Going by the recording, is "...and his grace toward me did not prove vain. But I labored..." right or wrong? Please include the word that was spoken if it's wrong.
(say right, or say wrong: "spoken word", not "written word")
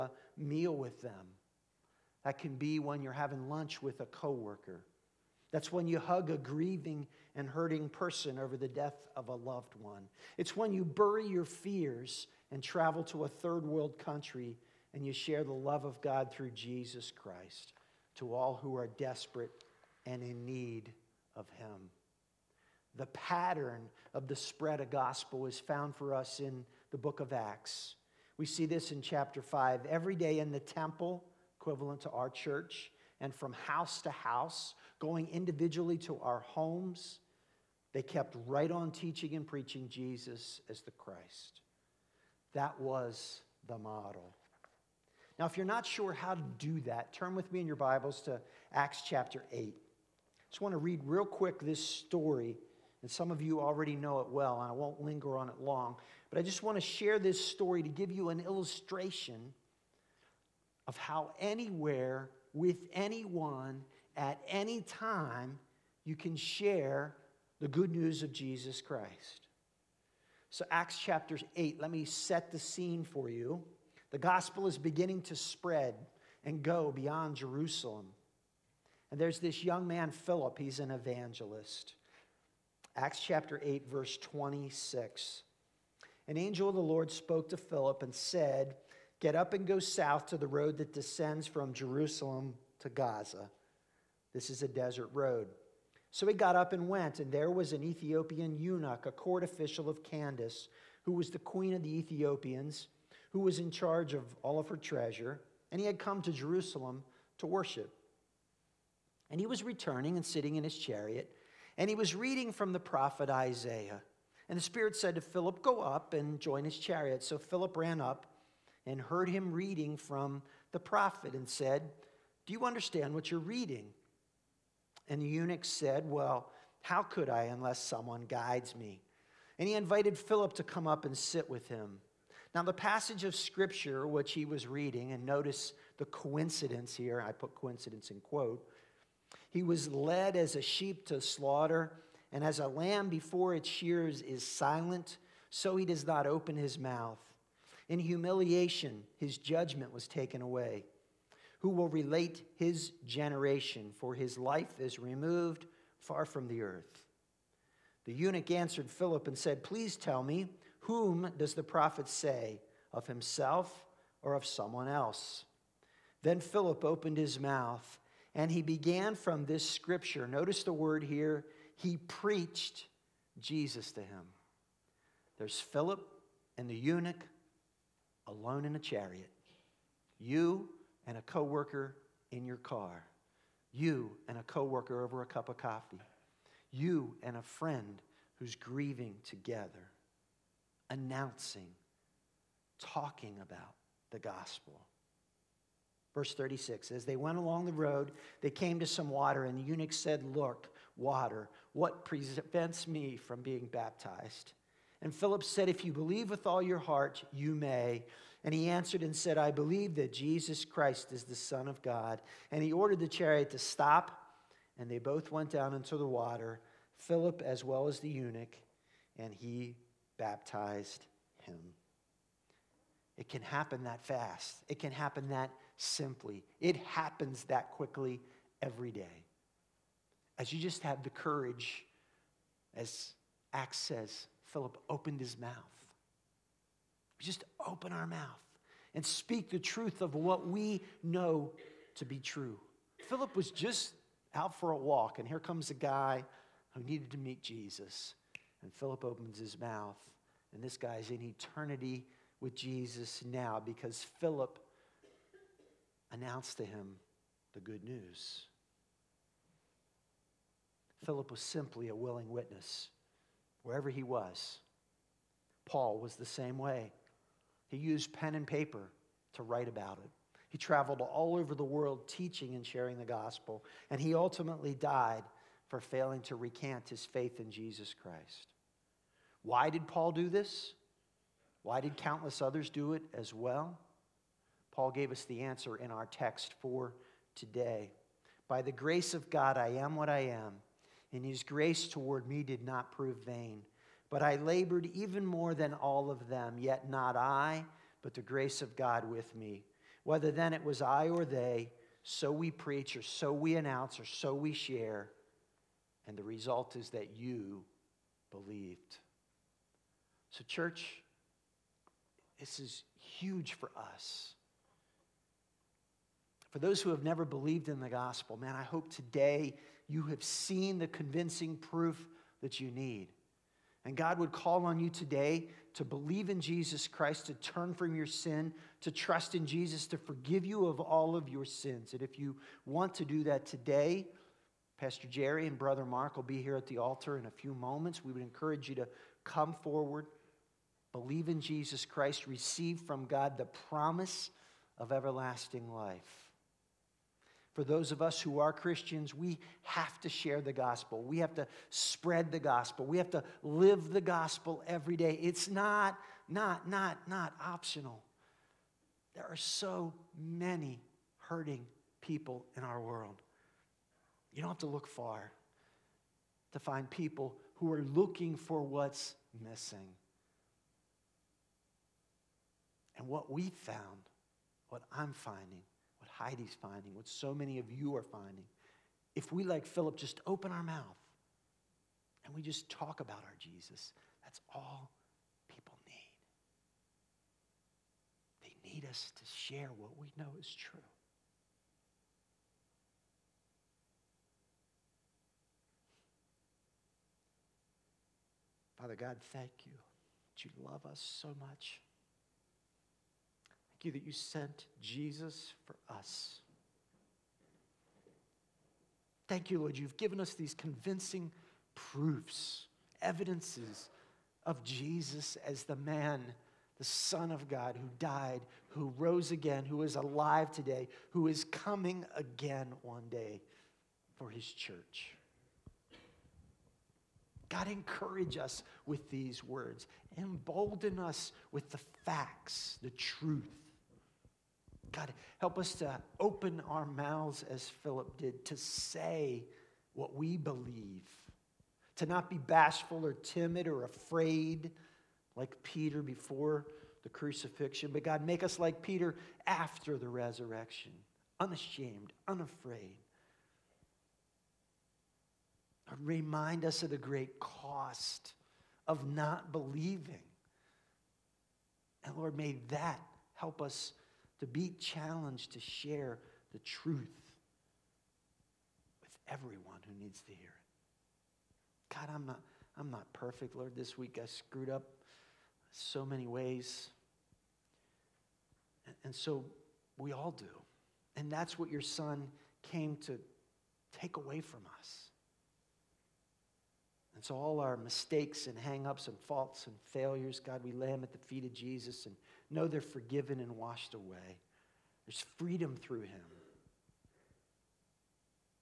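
right.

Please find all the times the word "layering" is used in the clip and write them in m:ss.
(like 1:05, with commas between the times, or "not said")
not said.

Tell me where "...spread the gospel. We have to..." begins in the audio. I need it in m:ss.
5:51.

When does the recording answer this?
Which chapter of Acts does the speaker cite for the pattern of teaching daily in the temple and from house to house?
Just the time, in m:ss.
0:29.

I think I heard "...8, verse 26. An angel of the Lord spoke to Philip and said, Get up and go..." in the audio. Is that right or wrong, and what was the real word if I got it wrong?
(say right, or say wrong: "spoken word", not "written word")
right.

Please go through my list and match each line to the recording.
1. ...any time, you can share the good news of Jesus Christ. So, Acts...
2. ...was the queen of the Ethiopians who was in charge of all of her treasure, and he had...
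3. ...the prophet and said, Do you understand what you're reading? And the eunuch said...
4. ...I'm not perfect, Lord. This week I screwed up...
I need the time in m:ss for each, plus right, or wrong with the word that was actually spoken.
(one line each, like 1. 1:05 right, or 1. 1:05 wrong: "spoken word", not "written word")
1. 1:04 right
2. 1:41 right
3. 2:00 right
4. 7:52 right.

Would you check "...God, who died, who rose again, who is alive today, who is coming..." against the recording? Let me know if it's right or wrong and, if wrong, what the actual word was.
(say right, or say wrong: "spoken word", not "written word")
right.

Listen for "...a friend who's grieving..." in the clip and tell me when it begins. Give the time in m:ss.
3:07.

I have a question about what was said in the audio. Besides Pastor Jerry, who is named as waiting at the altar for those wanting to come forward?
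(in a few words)
Brother Mark.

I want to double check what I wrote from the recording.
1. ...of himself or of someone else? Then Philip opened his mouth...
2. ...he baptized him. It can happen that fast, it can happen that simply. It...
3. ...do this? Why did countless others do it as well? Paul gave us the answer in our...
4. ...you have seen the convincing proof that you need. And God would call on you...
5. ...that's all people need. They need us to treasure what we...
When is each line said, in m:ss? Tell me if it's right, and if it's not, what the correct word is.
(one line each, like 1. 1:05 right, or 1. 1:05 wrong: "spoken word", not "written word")
1. 2:42 right
2. 3:39 right
3. 4:40 right
4. 5:19 right
5. 6:24 wrong: "share", not "treasure".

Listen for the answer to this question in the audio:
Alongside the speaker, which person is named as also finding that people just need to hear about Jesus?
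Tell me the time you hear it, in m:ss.
6:16.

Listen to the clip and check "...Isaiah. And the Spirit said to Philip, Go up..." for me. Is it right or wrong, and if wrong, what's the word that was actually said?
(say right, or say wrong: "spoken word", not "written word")
right.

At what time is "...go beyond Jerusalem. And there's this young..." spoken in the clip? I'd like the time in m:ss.
1:16.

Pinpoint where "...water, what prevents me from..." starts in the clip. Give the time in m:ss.
3:20.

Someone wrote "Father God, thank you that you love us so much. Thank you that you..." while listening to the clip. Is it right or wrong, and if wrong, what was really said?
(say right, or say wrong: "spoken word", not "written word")
right.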